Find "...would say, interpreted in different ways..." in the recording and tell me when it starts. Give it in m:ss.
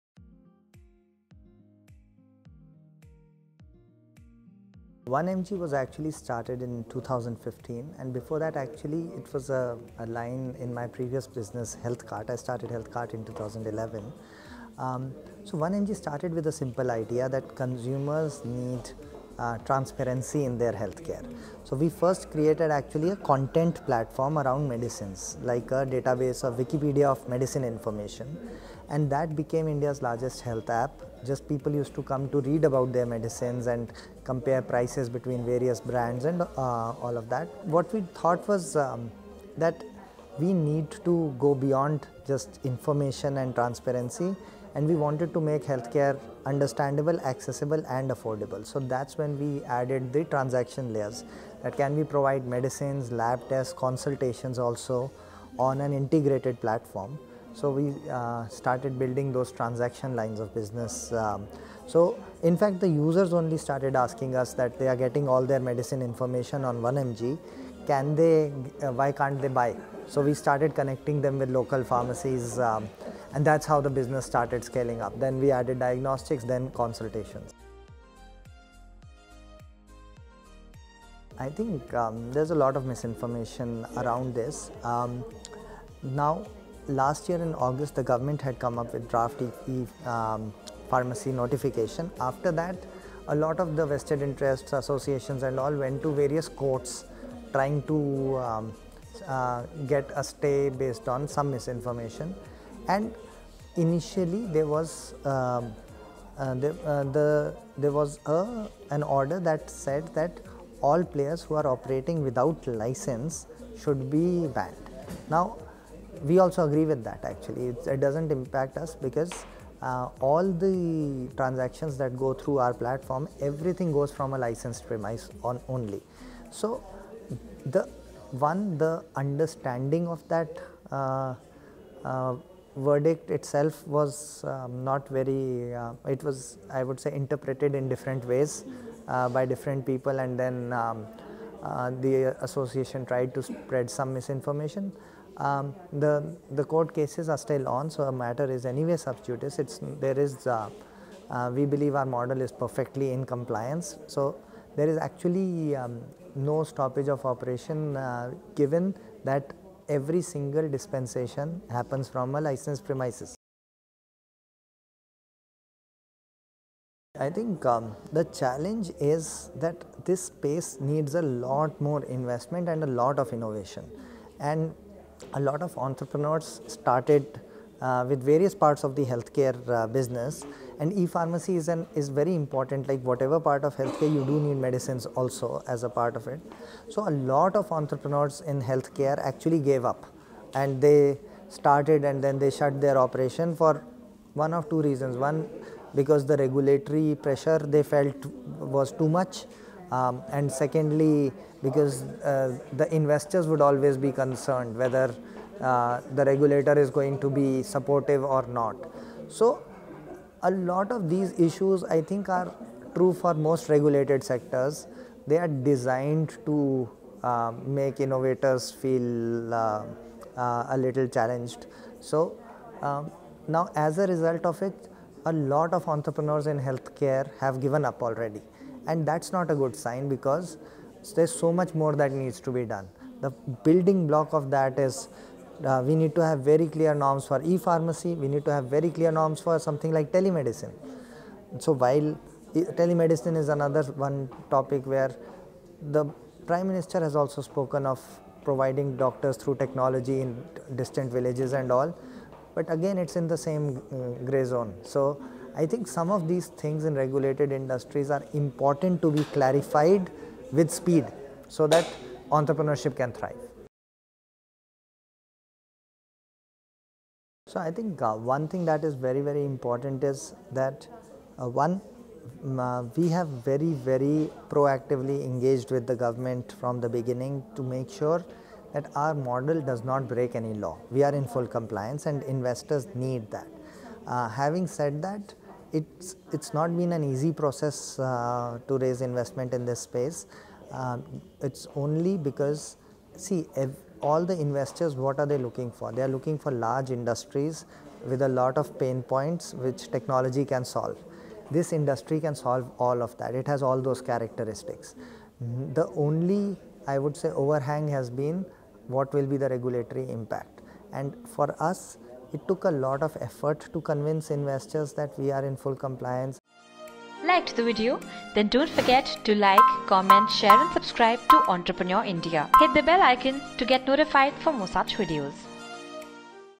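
2:16.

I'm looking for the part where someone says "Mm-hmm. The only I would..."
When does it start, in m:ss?
5:05.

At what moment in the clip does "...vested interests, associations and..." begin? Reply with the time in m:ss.
1:33.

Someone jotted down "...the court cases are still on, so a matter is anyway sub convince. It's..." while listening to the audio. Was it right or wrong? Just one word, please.
wrong.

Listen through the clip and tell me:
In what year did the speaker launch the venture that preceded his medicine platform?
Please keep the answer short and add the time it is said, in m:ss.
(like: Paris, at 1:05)
2011, at 0:13.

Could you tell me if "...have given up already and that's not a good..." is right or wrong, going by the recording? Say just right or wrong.
right.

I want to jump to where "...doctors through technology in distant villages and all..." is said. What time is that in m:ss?
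4:08.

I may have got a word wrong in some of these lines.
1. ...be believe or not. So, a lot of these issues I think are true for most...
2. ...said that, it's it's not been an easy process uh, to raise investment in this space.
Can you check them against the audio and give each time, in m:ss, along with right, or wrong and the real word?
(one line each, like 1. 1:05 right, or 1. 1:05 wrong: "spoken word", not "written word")
1. 3:27 wrong: "supportive", not "believe"
2. 4:44 right.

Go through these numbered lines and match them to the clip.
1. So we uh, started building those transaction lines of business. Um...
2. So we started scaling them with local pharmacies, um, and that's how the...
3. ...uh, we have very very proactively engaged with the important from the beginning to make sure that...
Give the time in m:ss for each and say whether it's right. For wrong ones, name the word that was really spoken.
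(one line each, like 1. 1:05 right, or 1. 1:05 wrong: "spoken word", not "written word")
1. 0:57 right
2. 1:10 wrong: "connecting", not "scaling"
3. 4:32 wrong: "government", not "important".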